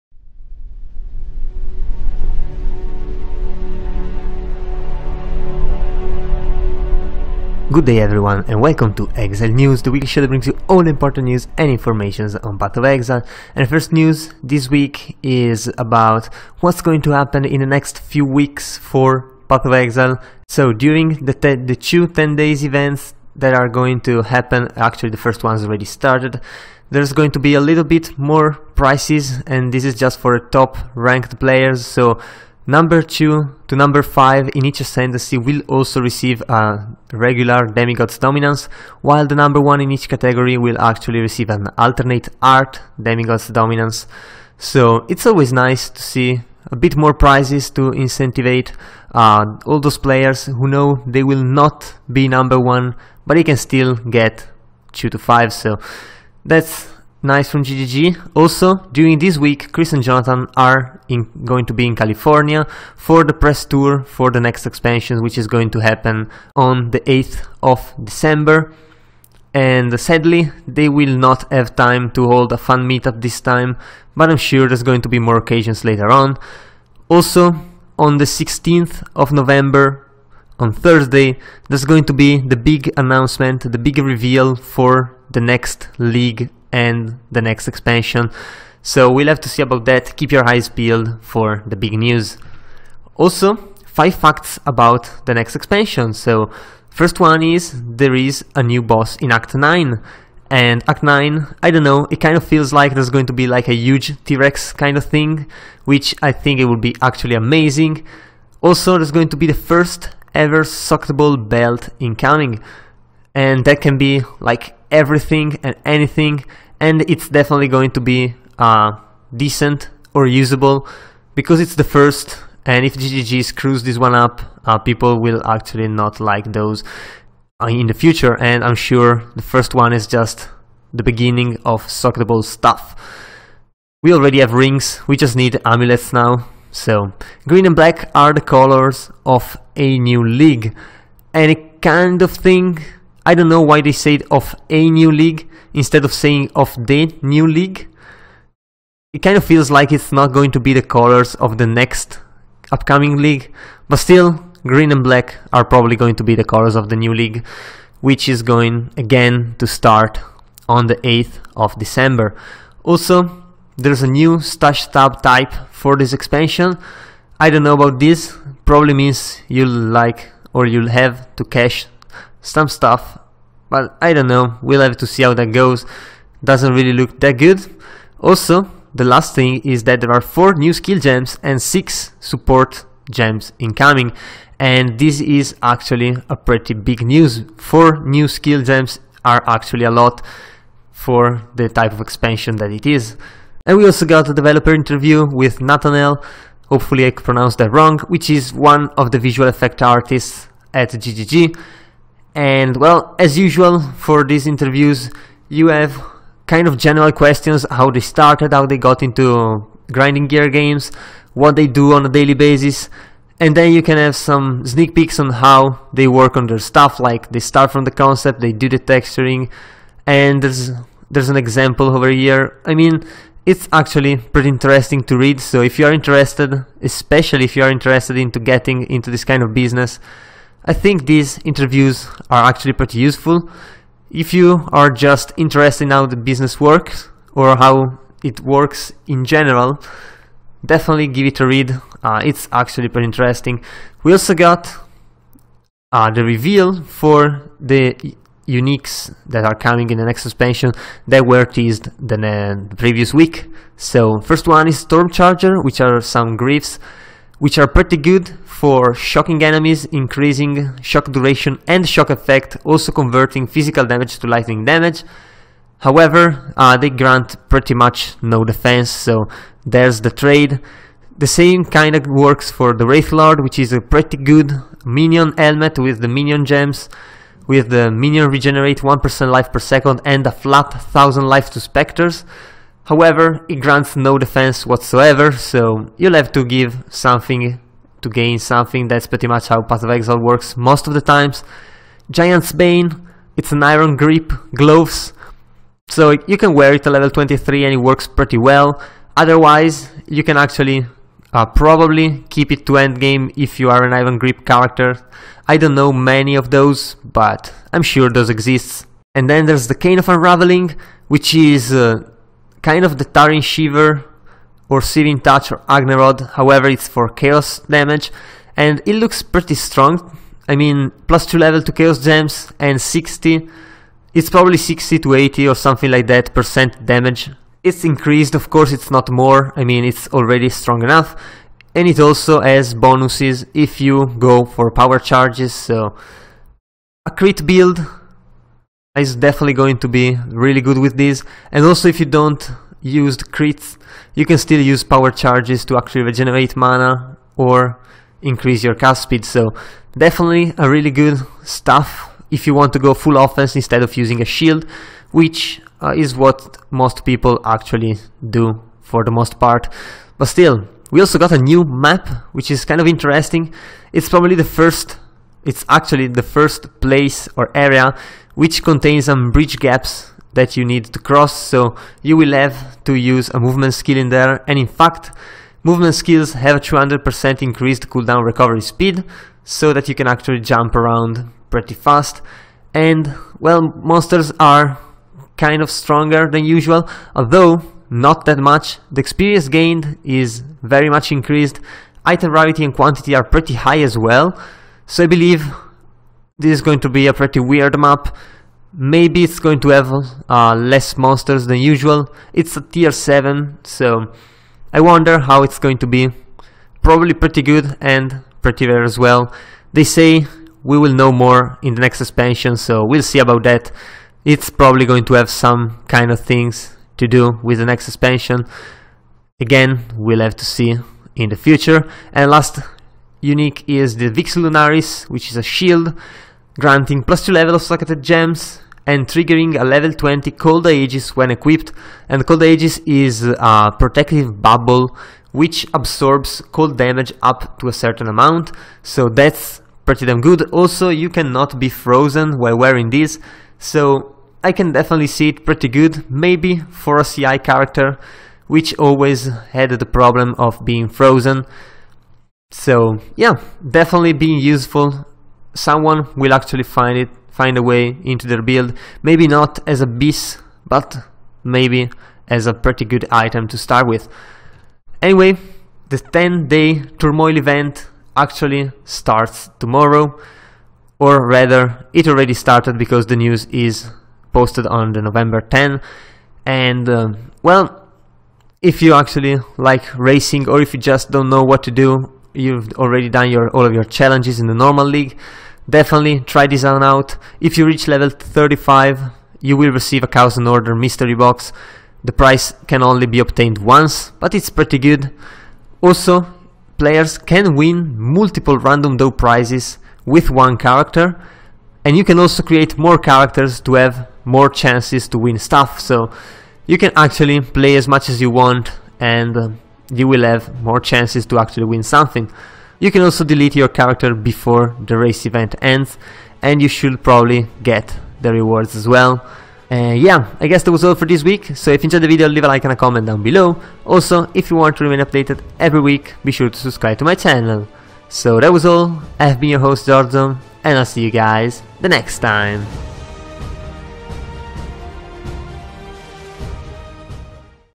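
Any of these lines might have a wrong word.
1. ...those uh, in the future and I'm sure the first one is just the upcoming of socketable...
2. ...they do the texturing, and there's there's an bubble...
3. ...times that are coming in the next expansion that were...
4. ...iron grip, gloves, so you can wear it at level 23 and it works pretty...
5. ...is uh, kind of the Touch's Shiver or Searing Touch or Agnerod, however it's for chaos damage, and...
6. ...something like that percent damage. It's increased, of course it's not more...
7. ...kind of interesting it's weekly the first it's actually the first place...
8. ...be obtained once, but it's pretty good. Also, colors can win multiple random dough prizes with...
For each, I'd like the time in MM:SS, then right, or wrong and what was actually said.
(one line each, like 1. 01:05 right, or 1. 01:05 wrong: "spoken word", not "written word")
1. 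02:06 wrong: "beginning", not "upcoming"
2. 03:38 wrong: "example", not "bubble"
3. 04:08 wrong: "uniques", not "times"
4. 04:53 right
5. 05:11 wrong: "Taryn", not "Touch"
6. 05:25 right
7. 06:02 wrong: "probably", not "weekly"
8. 08:13 wrong: "players", not "colors".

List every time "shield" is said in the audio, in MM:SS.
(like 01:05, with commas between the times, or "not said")
05:54, 07:05.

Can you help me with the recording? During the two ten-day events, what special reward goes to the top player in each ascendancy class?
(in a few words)
Alternate art Demigod's Dominance.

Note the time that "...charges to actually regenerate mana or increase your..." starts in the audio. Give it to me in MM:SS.
05:45.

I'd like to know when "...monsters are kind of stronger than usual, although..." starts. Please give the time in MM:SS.
06:23.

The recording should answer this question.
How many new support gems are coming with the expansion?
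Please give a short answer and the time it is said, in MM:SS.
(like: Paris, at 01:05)
6, at 03:01.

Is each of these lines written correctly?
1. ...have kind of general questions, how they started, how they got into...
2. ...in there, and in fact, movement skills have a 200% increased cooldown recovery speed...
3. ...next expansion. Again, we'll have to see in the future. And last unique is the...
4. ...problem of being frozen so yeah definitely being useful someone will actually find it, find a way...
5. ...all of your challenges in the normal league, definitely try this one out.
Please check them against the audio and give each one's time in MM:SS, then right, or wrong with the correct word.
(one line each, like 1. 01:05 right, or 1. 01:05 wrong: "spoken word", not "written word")
1. 03:25 right
2. 06:13 right
3. 06:57 right
4. 07:29 right
5. 08:03 right.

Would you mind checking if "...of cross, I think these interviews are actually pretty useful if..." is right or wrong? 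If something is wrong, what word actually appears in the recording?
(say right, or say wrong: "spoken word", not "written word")
wrong: "business", not "cross".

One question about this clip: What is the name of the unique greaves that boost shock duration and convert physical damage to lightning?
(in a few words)
Storm Charger.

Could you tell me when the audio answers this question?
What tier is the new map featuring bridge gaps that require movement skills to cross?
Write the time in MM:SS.
06:42.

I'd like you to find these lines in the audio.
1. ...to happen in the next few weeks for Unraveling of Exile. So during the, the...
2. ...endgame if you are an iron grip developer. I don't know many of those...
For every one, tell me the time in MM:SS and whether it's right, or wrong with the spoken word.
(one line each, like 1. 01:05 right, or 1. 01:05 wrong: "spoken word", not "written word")
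1. 00:17 wrong: "Path", not "Unraveling"
2. 05:02 wrong: "character", not "developer".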